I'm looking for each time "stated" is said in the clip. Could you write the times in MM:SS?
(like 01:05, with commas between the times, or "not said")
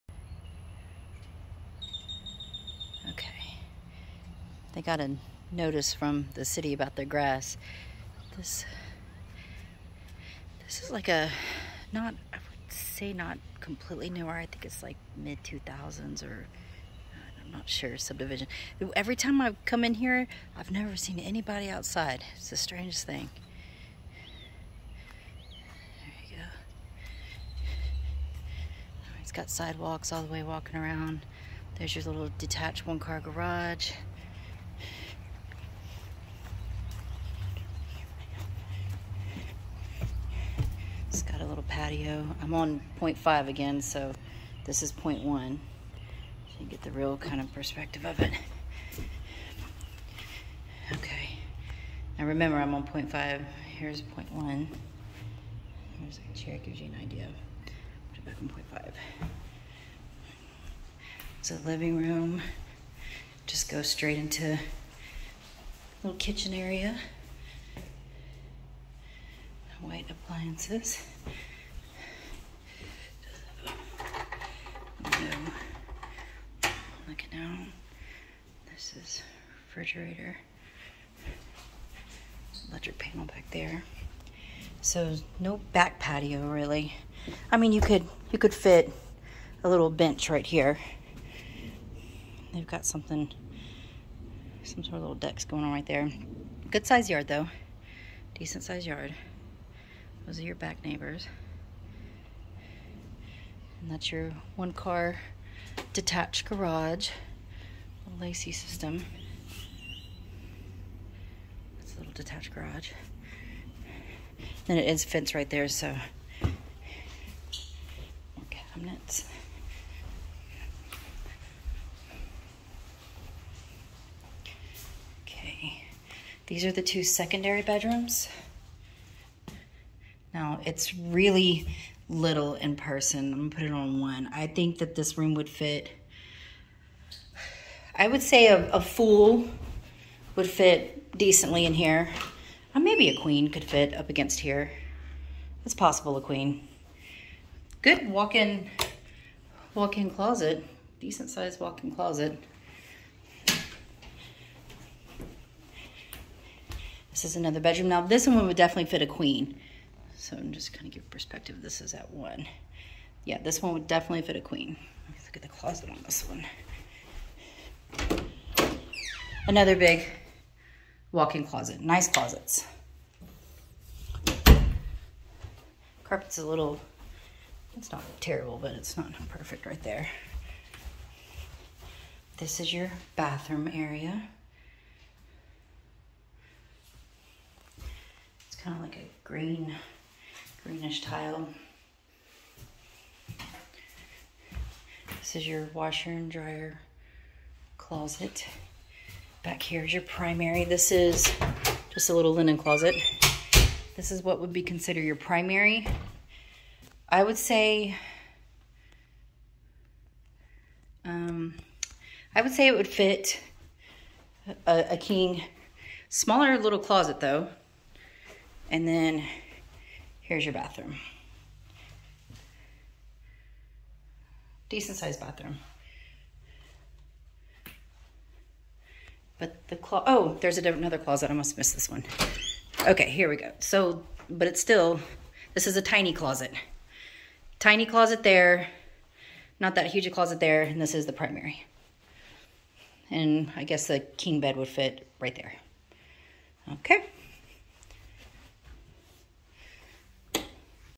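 not said.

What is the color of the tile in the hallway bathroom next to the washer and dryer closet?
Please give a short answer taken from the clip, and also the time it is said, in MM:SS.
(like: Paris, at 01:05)
greenish, at 03:10.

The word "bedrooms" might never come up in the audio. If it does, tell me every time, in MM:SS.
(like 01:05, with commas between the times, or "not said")
02:07, 02:37.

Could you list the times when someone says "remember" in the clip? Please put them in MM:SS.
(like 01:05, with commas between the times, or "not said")
00:52.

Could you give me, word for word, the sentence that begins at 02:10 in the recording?
Now it's really little in person.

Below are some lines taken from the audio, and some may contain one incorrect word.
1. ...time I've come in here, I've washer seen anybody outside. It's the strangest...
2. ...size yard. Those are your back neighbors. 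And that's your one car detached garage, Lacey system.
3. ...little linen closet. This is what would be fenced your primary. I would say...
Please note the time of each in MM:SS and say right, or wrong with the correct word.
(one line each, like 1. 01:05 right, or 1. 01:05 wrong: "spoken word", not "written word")
1. 00:19 wrong: "never", not "washer"
2. 01:38 right
3. 03:22 wrong: "considered", not "fenced".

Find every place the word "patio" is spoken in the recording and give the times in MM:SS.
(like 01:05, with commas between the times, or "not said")
00:41, 01:25.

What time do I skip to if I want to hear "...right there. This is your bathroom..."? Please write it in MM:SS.
02:59.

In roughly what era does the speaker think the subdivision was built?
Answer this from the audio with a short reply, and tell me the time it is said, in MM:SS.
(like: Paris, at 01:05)
mid 2000s, at 00:15.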